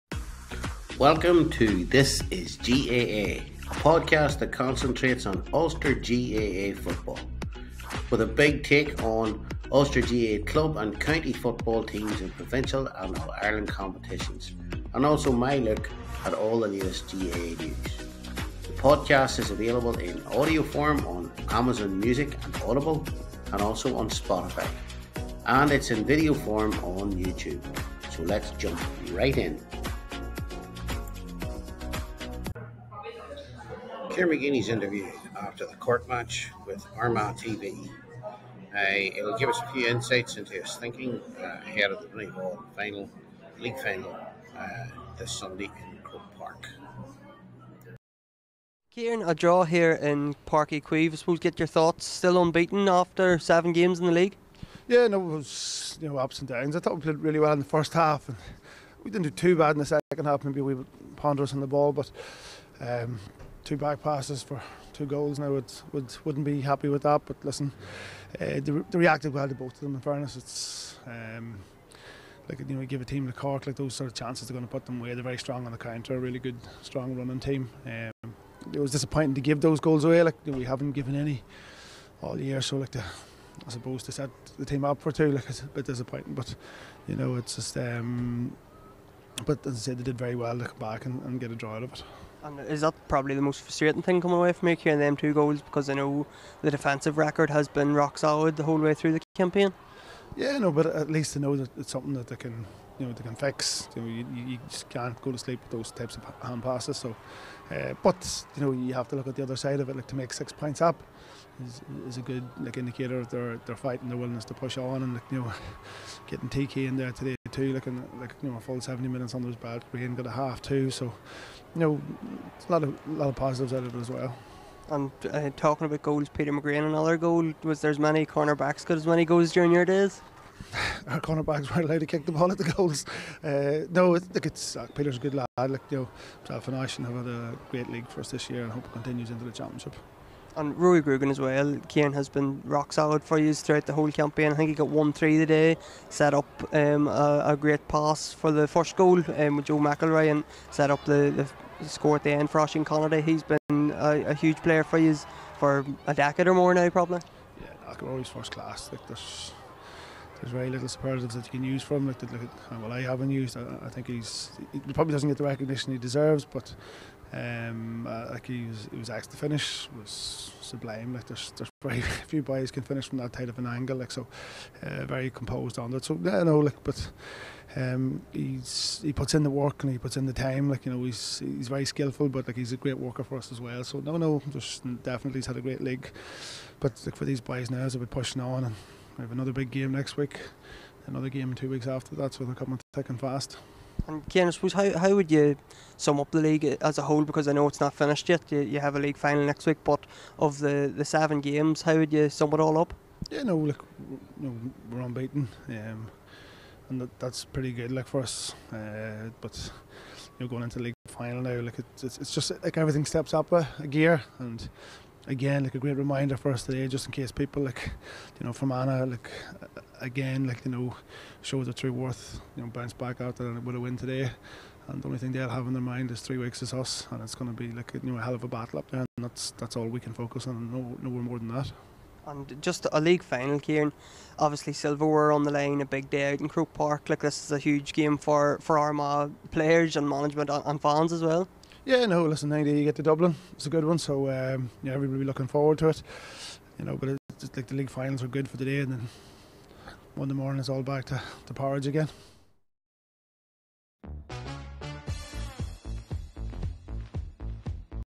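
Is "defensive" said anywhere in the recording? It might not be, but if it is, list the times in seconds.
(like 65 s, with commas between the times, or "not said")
96 s.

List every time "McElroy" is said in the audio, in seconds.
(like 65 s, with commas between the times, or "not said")
149 s, 157 s.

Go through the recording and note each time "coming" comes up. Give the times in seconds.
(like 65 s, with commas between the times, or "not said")
94 s, 192 s.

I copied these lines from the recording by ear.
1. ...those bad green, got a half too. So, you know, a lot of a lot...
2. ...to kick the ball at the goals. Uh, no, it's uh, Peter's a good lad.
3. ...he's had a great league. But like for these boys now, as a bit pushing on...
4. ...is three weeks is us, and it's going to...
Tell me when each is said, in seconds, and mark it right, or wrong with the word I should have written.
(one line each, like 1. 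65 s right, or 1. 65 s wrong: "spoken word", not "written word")
1. 119 s right
2. 132 s right
3. 185 s right
4. 226 s right.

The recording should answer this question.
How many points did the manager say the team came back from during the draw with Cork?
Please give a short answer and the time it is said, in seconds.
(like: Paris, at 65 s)
6, at 110 s.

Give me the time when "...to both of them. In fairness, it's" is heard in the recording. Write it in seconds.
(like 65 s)
69 s.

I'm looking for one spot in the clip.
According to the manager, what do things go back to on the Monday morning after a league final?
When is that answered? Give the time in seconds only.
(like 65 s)
251 s.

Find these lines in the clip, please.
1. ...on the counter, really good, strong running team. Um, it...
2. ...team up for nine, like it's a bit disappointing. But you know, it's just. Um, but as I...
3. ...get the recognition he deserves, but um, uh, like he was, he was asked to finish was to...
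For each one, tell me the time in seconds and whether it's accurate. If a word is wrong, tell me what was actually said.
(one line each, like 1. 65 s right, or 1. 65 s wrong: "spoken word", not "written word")
1. 75 s right
2. 84 s wrong: "two", not "nine"
3. 165 s right.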